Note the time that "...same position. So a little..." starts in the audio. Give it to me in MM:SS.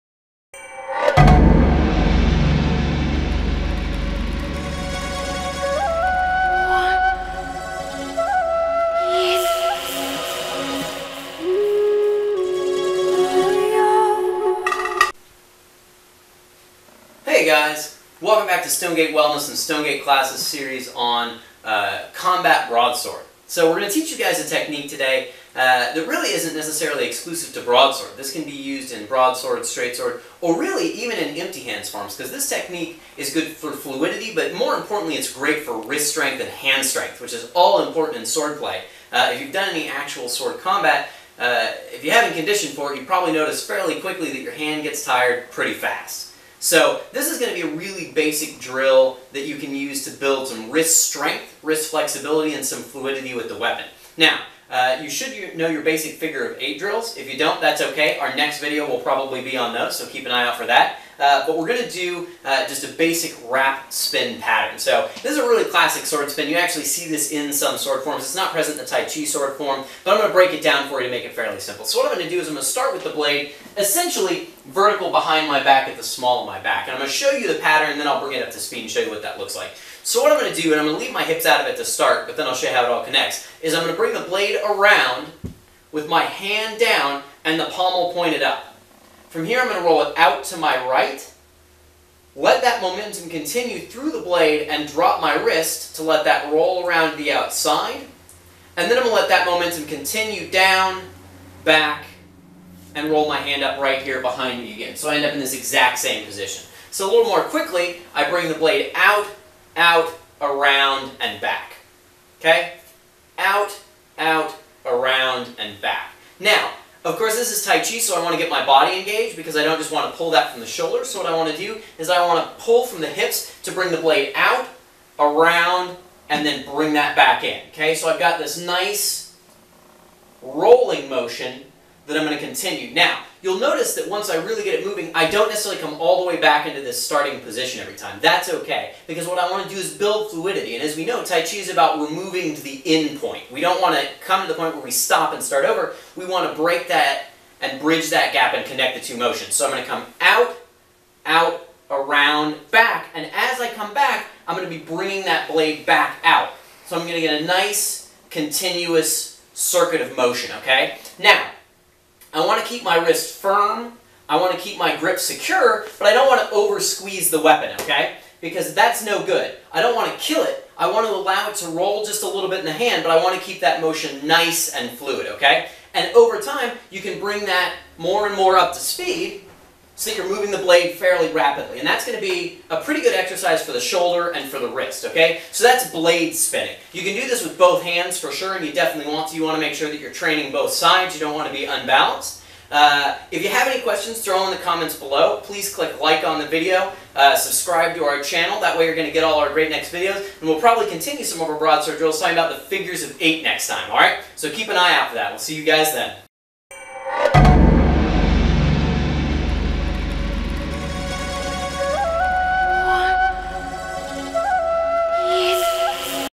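01:45.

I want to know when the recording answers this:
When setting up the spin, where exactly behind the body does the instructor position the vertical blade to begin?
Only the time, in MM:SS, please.
01:16.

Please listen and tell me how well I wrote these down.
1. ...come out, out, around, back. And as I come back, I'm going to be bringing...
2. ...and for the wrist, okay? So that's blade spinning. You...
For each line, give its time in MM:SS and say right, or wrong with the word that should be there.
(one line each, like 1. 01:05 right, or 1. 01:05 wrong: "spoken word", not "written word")
1. 02:29 right
2. 03:04 right.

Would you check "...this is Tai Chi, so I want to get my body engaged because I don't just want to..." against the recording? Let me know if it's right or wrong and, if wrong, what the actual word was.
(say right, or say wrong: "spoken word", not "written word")
right.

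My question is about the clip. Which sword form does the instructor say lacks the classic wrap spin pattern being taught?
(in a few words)
Tai Chi sword form.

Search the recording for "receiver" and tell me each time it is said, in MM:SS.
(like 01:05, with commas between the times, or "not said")
not said.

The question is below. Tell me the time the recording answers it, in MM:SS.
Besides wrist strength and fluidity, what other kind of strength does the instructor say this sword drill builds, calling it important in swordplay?
00:36.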